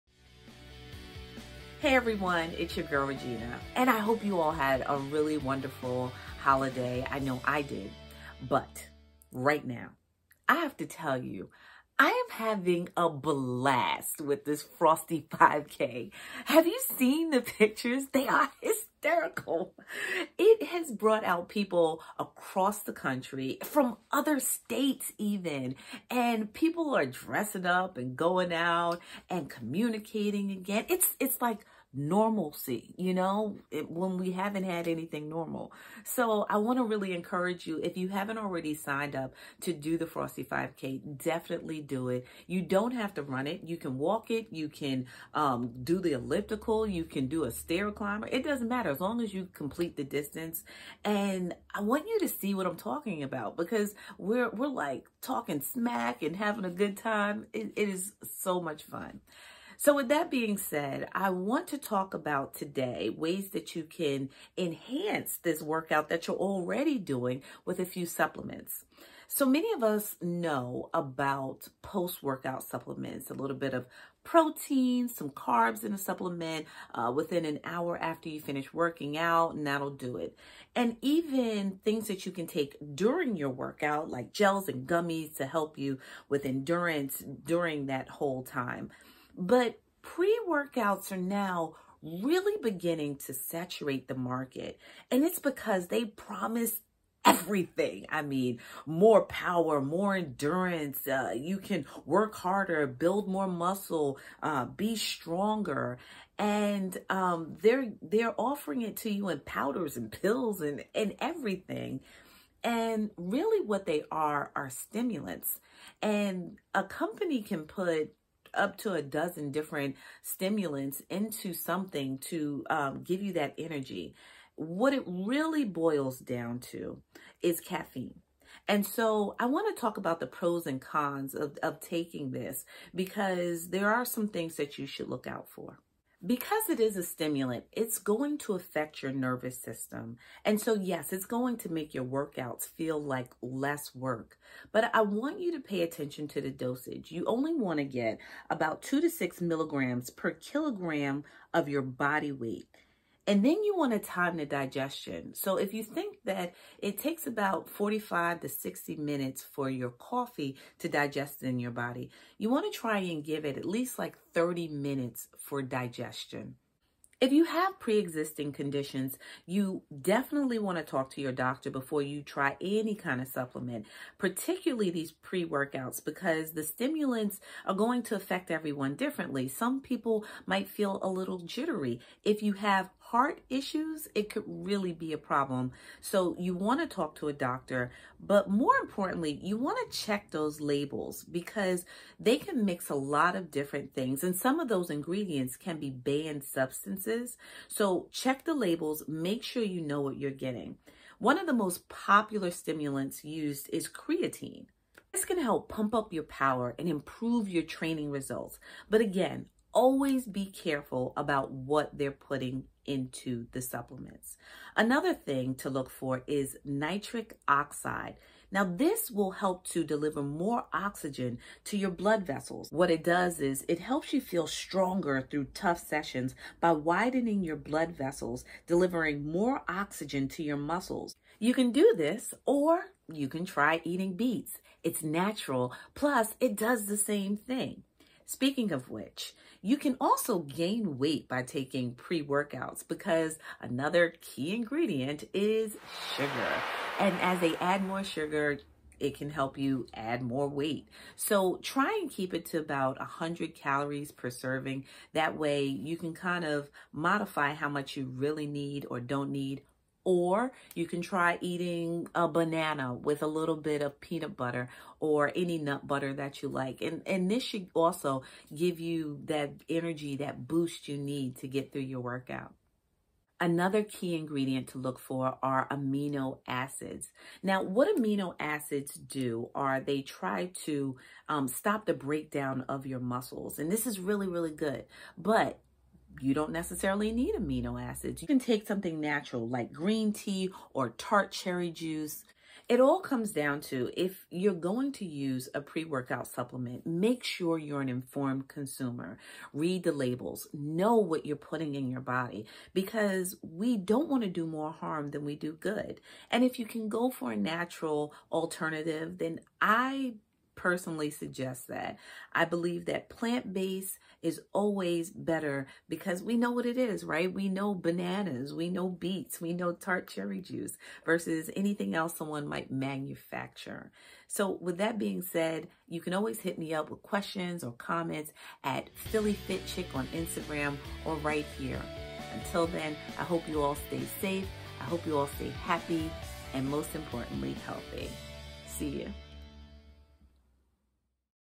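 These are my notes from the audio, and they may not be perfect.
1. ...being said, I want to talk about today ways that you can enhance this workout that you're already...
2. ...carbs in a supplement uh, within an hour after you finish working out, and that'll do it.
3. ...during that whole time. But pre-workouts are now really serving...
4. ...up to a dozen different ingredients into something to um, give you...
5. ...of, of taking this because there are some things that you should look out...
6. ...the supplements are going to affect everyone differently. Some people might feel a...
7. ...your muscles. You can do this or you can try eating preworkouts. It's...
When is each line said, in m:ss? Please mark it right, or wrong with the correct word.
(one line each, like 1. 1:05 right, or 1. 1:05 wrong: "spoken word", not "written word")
1. 1:00 right
2. 1:15 right
3. 1:27 wrong: "beginning", not "serving"
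4. 1:58 wrong: "stimulants", not "ingredients"
5. 2:11 right
6. 2:56 wrong: "stimulants", not "supplements"
7. 3:50 wrong: "beets", not "preworkouts".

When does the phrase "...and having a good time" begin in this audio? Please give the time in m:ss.
0:56.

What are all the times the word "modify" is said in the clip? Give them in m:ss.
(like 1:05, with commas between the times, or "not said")
4:16.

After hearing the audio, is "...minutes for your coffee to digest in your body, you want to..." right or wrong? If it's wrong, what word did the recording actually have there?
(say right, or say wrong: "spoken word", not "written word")
right.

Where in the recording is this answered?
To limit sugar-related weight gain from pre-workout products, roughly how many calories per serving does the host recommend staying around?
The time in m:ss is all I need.
4:12.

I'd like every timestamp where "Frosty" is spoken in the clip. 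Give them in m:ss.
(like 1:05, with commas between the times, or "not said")
0:14, 0:40.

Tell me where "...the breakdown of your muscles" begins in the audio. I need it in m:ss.
4:41.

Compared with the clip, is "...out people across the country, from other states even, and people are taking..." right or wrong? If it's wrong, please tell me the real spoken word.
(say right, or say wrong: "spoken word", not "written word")
wrong: "dressing", not "taking".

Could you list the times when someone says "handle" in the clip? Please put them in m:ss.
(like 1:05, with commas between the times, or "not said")
not said.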